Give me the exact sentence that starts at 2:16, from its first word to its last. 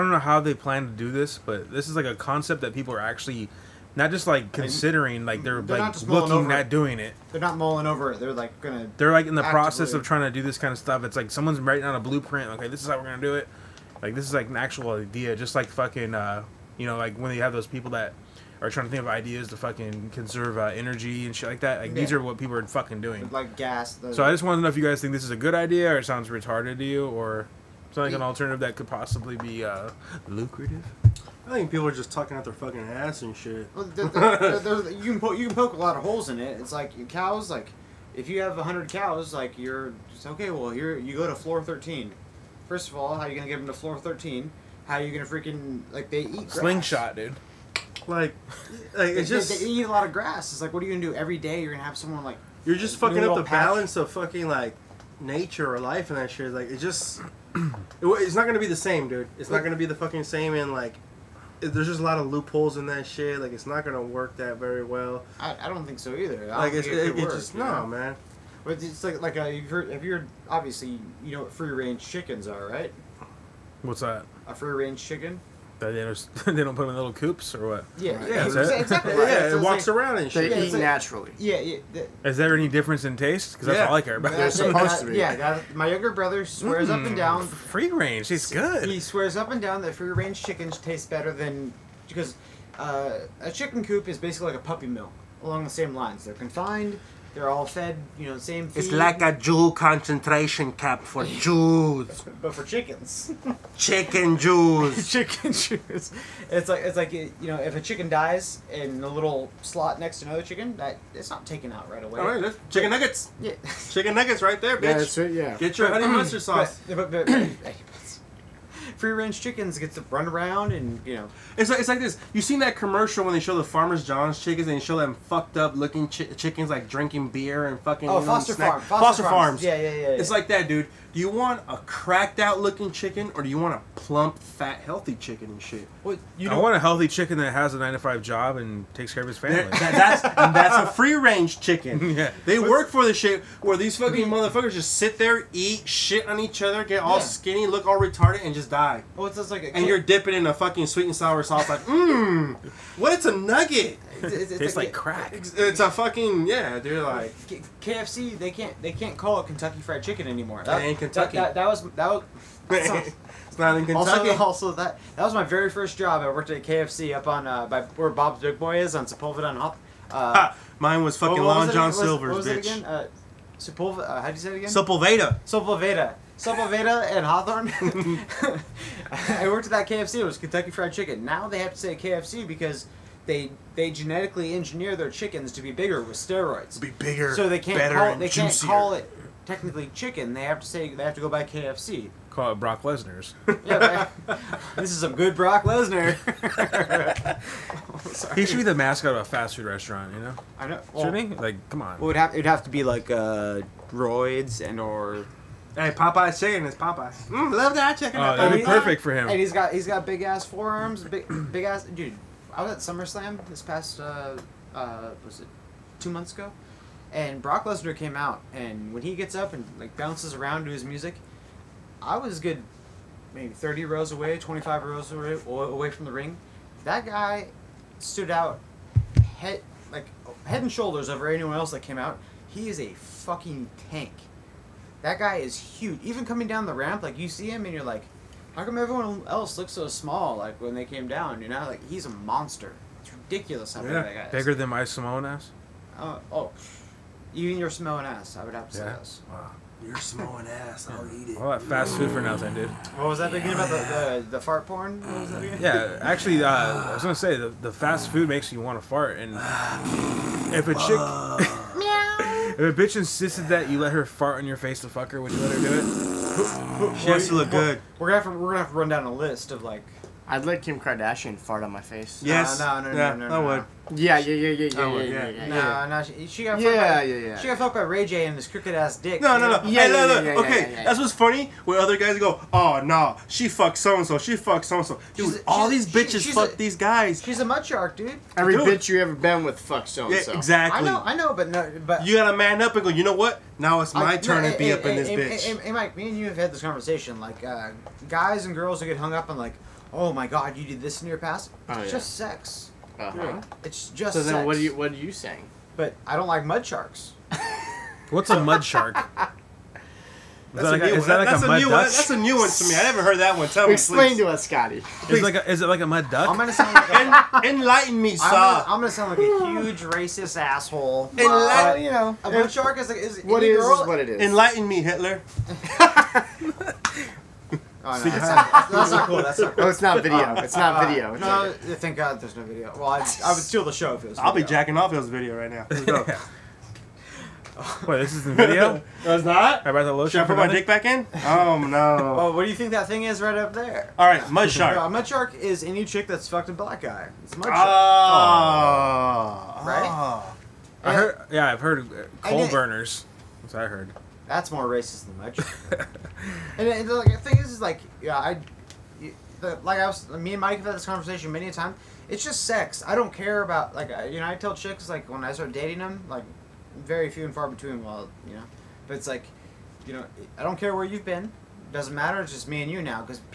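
you I want a healthy chicken that has a nine to five job and takes care of his family.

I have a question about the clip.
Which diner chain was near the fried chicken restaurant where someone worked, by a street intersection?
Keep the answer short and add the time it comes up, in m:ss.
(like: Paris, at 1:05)
Bob's Big Boy, at 2:48.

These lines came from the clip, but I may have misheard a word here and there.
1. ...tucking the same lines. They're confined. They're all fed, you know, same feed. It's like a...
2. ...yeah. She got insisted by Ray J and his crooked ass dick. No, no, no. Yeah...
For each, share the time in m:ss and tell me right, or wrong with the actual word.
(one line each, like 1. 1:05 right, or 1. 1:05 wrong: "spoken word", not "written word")
1. 1:35 wrong: "along", not "tucking"
2. 4:37 wrong: "fucked", not "insisted".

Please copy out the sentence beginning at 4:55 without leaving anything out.
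Hey, Mike, me and you have had this conversation.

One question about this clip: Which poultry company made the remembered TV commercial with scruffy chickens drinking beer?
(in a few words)
Foster Farms.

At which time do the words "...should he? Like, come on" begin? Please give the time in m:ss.
3:21.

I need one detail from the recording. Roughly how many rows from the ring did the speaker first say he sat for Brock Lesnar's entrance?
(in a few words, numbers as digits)
30.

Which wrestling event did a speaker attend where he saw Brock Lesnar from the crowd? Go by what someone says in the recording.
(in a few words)
SummerSlam.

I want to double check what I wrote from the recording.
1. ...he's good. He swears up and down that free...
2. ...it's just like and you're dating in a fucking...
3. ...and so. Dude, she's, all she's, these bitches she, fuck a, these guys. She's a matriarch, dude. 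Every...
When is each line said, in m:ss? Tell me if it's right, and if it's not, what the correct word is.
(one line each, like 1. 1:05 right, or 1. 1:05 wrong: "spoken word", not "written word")
1. 1:28 right
2. 2:29 wrong: "dipping", not "dating"
3. 4:44 right.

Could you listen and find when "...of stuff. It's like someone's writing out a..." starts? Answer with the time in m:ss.
0:10.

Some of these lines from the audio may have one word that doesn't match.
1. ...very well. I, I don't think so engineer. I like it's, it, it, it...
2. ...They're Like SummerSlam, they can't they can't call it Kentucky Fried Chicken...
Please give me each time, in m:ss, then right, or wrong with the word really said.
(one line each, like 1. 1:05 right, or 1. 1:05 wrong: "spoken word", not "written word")
1. 1:04 wrong: "either", not "engineer"
2. 2:36 wrong: "KFC", not "SummerSlam".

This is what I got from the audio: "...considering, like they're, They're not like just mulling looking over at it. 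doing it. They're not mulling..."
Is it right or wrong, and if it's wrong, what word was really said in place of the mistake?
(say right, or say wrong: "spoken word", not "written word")
right.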